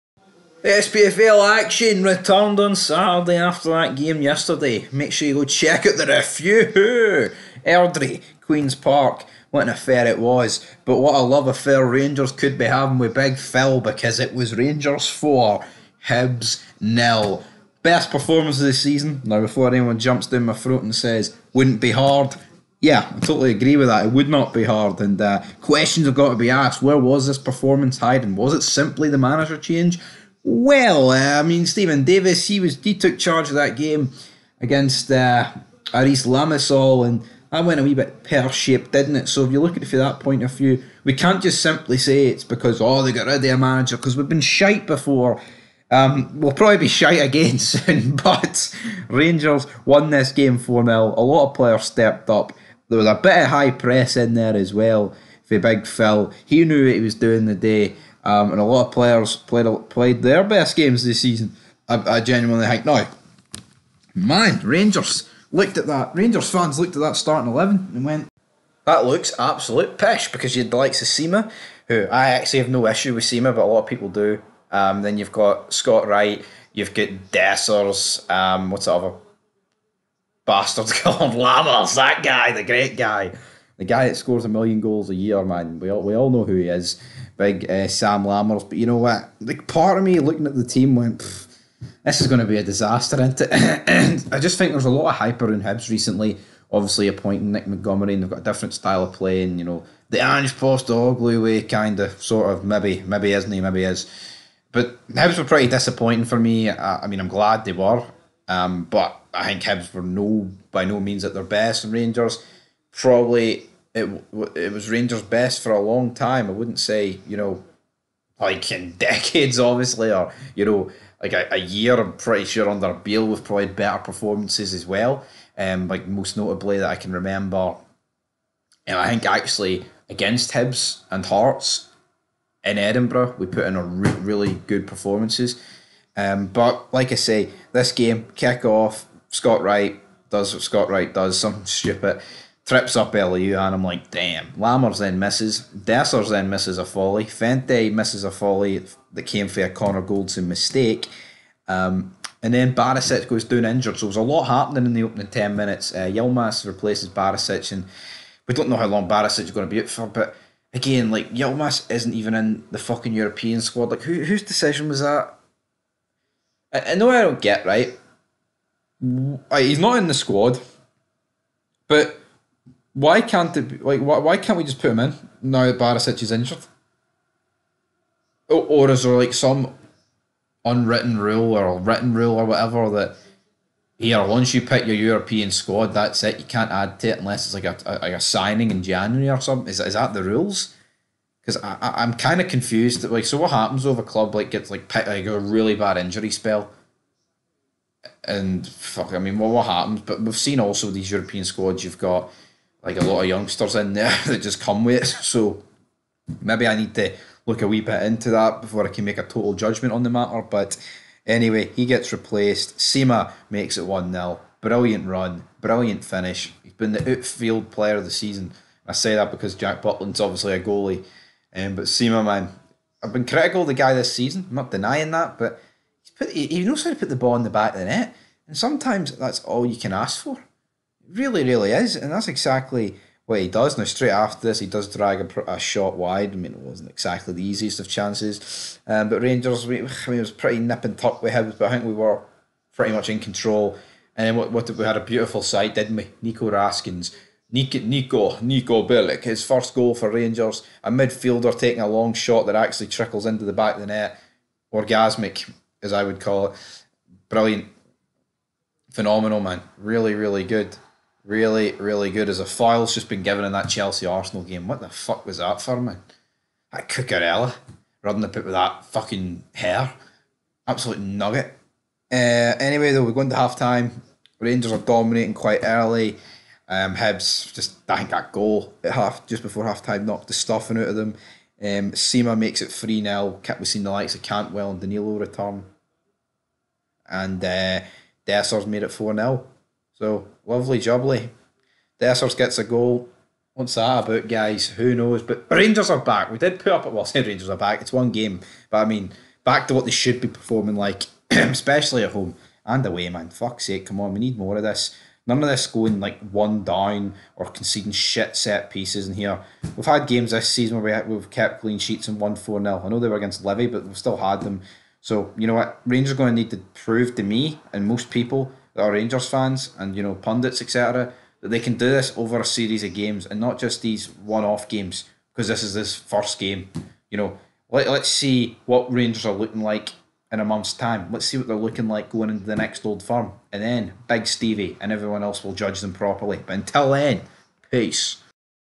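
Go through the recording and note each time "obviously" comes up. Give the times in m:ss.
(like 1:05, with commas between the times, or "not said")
1:36, 1:59, 3:40.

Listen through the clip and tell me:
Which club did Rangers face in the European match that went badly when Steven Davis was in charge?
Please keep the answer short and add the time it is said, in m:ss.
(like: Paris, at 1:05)
Aris Limassol, at 0:35.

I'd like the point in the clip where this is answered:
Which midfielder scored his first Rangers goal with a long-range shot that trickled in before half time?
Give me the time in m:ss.
4:08.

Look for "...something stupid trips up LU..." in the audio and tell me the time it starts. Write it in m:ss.
2:21.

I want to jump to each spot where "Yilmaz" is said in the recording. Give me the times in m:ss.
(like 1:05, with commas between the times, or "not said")
2:36, 2:41.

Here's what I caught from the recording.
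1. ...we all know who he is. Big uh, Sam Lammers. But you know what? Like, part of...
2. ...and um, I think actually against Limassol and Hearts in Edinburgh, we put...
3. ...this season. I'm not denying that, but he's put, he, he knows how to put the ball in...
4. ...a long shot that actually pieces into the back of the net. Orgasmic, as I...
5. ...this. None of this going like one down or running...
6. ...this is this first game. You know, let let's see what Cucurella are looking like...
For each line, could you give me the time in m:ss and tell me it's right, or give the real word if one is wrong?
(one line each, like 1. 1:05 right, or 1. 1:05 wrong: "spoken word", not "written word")
1. 1:26 right
2. 2:08 wrong: "Hibs", not "Limassol"
3. 3:43 right
4. 4:11 wrong: "trickles", not "pieces"
5. 5:04 wrong: "conceding", not "running"
6. 5:25 wrong: "Rangers", not "Cucurella".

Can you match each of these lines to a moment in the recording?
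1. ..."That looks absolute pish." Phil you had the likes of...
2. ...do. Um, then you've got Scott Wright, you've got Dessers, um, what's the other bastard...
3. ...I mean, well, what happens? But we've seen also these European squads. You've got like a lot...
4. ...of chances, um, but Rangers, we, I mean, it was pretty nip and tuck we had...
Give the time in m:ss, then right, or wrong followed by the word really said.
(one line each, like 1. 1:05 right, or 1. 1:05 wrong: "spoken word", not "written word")
1. 1:08 wrong: "Because", not "Phil"
2. 1:14 right
3. 3:19 right
4. 3:57 right.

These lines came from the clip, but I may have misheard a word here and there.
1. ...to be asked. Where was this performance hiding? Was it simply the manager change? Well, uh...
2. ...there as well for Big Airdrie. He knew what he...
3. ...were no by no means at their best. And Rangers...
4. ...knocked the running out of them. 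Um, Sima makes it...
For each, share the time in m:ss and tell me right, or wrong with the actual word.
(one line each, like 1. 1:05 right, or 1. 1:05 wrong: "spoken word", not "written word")
1. 0:26 right
2. 0:54 wrong: "Phil", not "Airdrie"
3. 1:49 right
4. 4:40 wrong: "stuffing", not "running".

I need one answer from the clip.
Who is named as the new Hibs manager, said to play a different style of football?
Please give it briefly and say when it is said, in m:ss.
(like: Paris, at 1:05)
Nick Montgomery, at 1:37.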